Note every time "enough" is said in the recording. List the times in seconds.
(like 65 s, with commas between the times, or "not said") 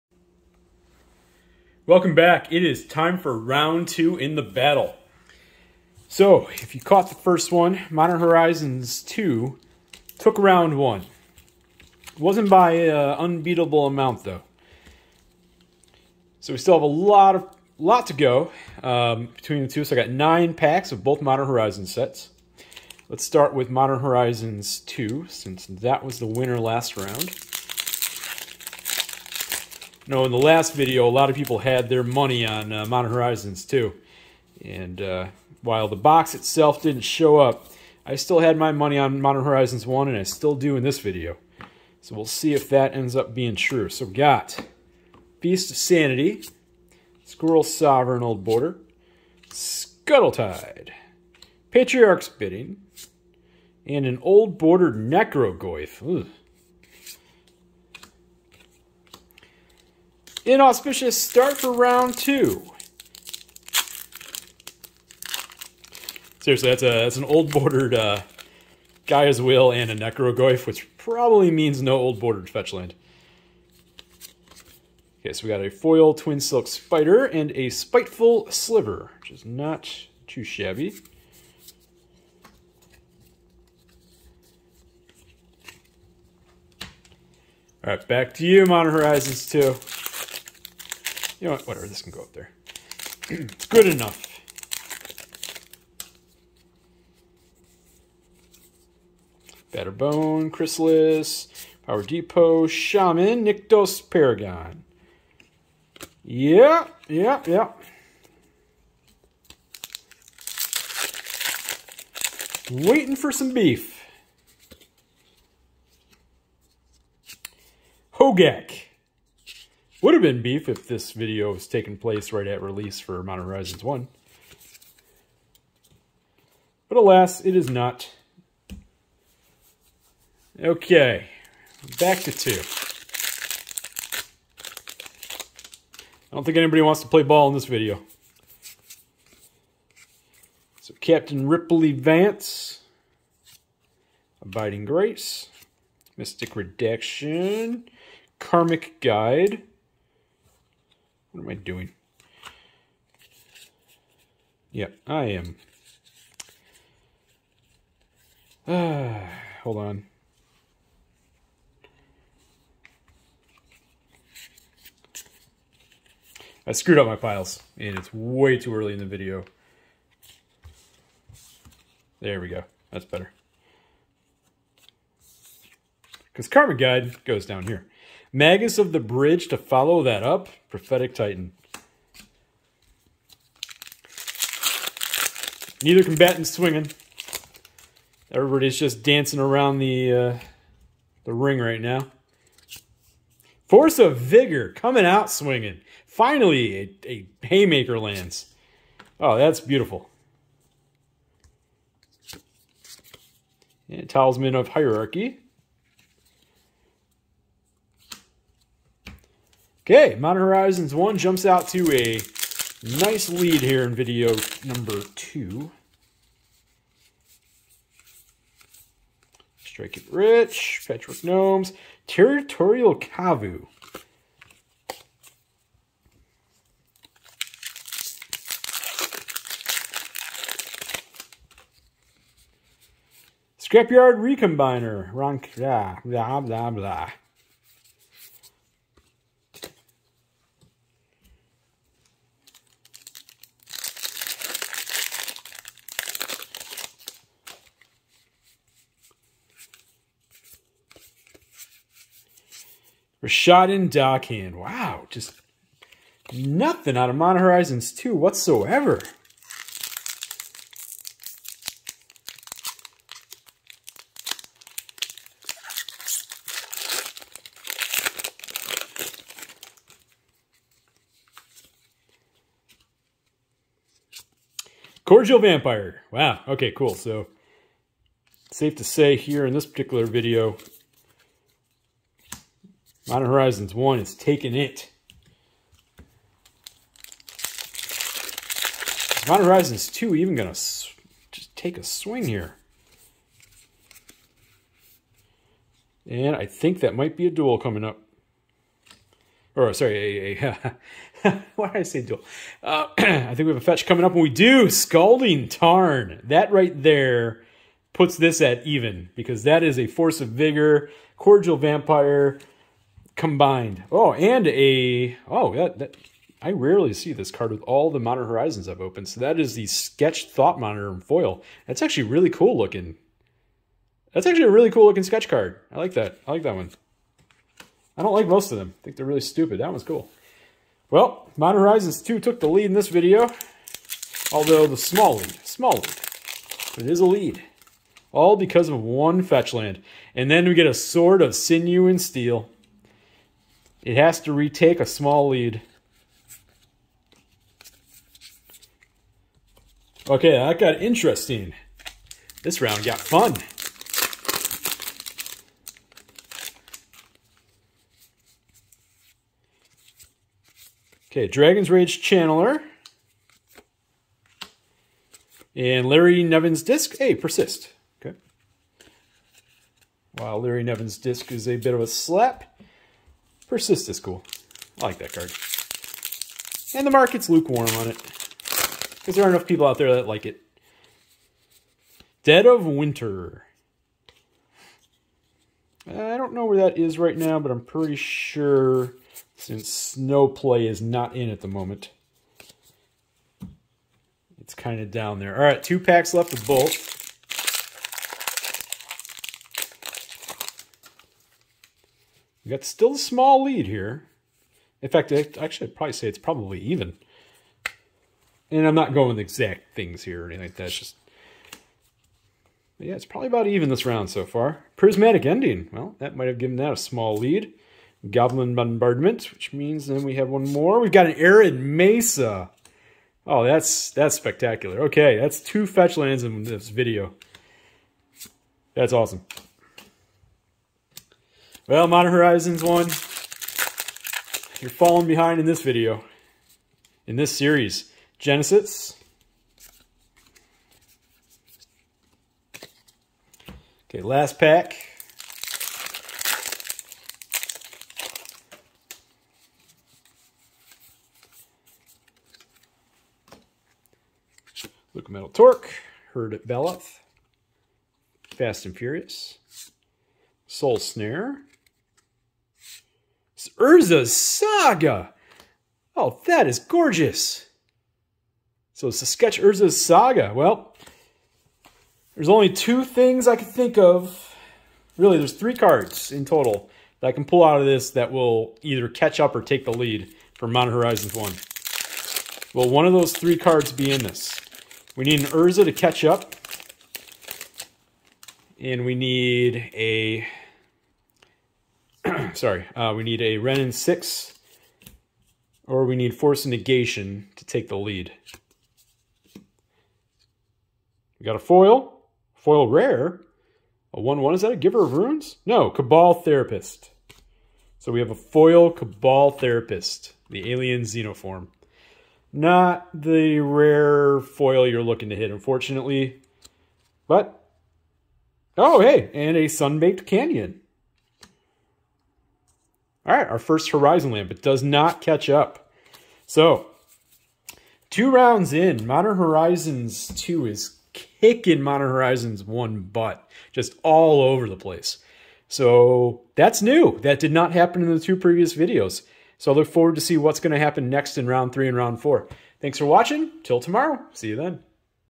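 93 s, 379 s.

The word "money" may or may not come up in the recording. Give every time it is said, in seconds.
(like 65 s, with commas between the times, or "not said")
32 s, 38 s.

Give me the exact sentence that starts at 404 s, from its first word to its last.
In fact, I actually I'd probably say it's probably even.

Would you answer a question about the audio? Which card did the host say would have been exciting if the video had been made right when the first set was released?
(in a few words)
Hogak.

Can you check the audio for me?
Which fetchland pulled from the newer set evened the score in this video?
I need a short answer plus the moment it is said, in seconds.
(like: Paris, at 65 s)
Scalding Tarn, at 304 s.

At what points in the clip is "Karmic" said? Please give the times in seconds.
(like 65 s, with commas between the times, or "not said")
148 s, 176 s.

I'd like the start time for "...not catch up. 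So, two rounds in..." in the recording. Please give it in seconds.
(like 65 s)
524 s.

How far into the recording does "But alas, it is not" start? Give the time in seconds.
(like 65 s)
126 s.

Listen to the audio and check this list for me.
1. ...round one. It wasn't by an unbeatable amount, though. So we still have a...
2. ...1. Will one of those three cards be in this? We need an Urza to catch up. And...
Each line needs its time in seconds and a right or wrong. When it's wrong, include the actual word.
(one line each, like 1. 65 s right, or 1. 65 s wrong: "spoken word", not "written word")
1. 10 s right
2. 481 s right.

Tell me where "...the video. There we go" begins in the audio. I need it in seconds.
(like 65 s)
168 s.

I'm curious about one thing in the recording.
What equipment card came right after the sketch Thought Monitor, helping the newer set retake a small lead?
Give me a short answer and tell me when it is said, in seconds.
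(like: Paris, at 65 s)
Sword of Sinew and Steel, at 340 s.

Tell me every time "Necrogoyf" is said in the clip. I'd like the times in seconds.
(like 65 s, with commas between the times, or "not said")
54 s, 69 s.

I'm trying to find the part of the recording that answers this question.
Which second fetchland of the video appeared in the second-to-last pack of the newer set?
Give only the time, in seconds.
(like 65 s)
421 s.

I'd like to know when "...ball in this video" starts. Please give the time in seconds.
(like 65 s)
137 s.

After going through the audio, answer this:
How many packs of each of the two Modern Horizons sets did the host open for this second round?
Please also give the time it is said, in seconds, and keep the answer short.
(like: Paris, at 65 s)
9, at 20 s.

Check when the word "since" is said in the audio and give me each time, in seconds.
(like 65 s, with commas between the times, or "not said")
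25 s, 389 s.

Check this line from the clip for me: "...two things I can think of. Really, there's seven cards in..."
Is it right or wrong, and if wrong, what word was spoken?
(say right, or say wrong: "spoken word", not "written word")
wrong: "three", not "seven".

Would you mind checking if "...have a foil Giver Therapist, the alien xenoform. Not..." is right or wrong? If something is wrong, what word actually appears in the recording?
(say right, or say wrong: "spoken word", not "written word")
wrong: "Cabal", not "Giver".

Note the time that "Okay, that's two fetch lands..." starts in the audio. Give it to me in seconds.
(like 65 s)
424 s.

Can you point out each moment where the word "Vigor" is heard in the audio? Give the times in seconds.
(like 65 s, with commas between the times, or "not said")
194 s, 310 s.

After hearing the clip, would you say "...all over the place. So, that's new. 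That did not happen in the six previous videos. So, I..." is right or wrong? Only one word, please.
wrong.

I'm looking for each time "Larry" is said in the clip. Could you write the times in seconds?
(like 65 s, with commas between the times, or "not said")
365 s, 370 s.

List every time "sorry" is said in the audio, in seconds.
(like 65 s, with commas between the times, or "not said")
299 s, 492 s.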